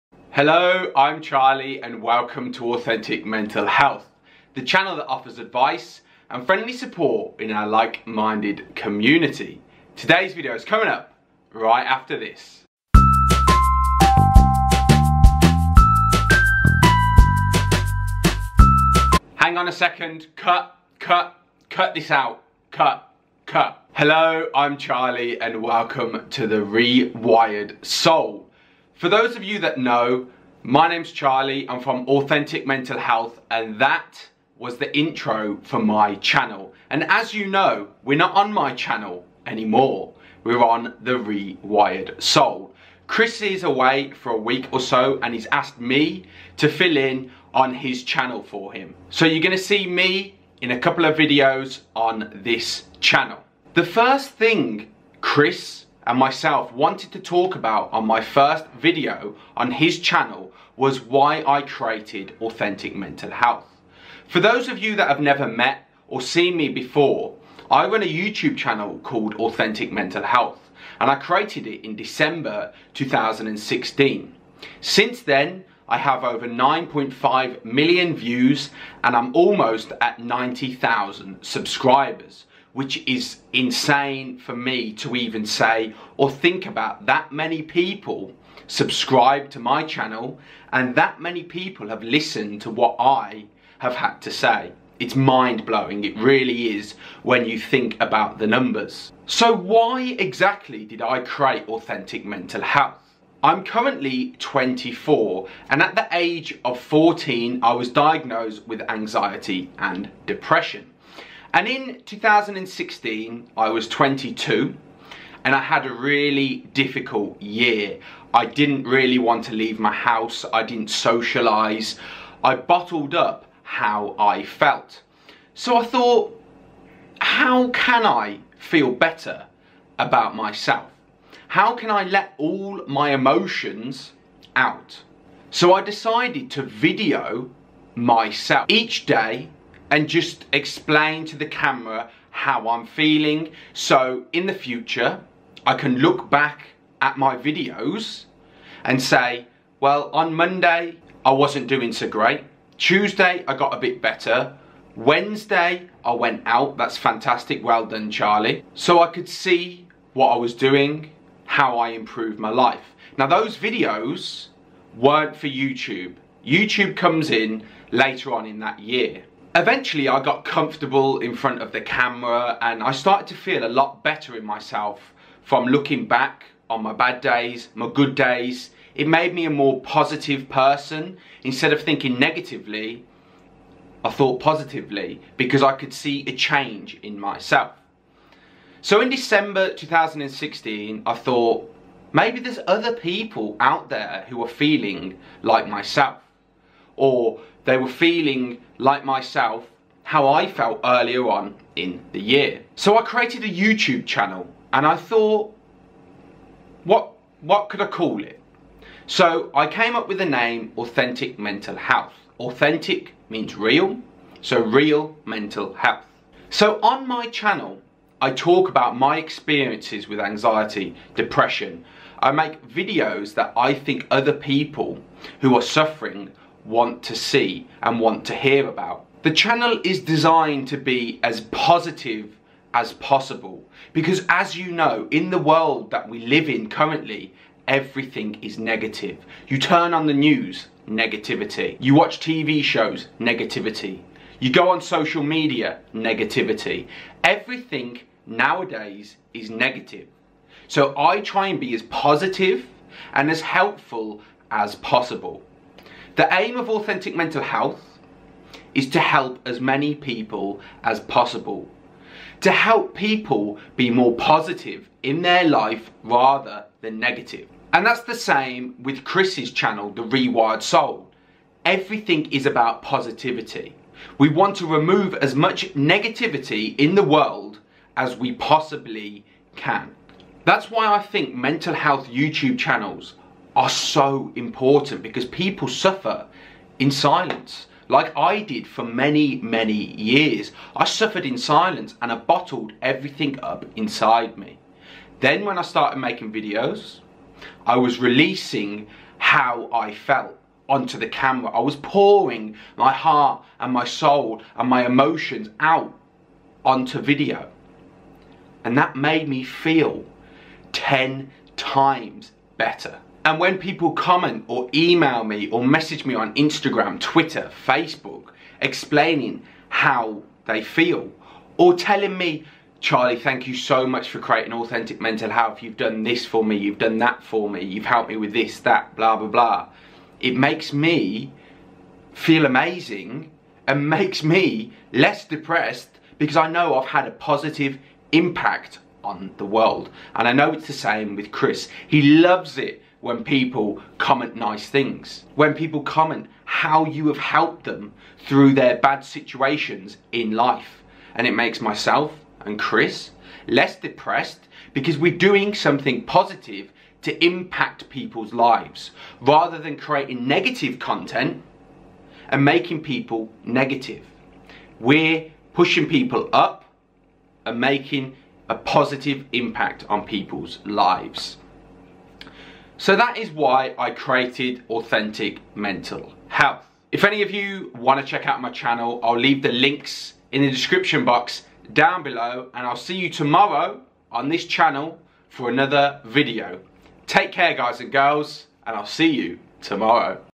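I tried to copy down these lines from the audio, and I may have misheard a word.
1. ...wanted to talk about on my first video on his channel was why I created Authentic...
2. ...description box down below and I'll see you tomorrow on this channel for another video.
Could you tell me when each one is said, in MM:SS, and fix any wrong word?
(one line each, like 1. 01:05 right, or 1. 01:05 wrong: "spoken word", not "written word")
1. 00:56 right
2. 06:20 right.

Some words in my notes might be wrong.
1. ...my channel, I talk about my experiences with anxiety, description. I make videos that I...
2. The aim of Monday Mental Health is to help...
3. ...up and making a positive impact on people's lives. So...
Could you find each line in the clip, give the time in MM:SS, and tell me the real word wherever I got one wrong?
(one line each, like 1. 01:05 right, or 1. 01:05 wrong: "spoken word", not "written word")
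1. 03:37 wrong: "depression", not "description"
2. 04:16 wrong: "Authentic", not "Monday"
3. 06:06 right.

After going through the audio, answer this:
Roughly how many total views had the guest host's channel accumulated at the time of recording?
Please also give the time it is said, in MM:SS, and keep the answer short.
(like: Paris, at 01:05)
9.5 million, at 01:16.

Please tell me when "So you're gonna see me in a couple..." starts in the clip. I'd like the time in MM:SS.
00:49.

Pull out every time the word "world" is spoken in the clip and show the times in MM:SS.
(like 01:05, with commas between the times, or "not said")
03:55, 04:37, 05:39.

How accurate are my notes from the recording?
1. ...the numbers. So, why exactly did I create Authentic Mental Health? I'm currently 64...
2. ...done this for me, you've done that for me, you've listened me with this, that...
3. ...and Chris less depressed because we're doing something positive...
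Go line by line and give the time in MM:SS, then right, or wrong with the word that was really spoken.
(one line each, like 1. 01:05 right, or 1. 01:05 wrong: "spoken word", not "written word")
1. 01:38 wrong: "24", not "64"
2. 05:25 wrong: "helped", not "listened"
3. 05:52 right.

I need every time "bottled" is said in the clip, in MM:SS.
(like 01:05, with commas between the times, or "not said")
02:02, 04:52.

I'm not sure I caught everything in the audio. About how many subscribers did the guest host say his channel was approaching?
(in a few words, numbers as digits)
90,000.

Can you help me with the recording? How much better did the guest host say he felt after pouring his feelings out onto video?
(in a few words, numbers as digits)
10 times.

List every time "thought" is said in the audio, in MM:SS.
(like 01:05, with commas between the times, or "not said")
02:05, 03:04, 03:11, 03:24.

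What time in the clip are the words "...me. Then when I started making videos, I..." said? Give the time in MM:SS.
04:54.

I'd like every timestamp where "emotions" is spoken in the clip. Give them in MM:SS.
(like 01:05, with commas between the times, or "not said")
02:13, 05:04.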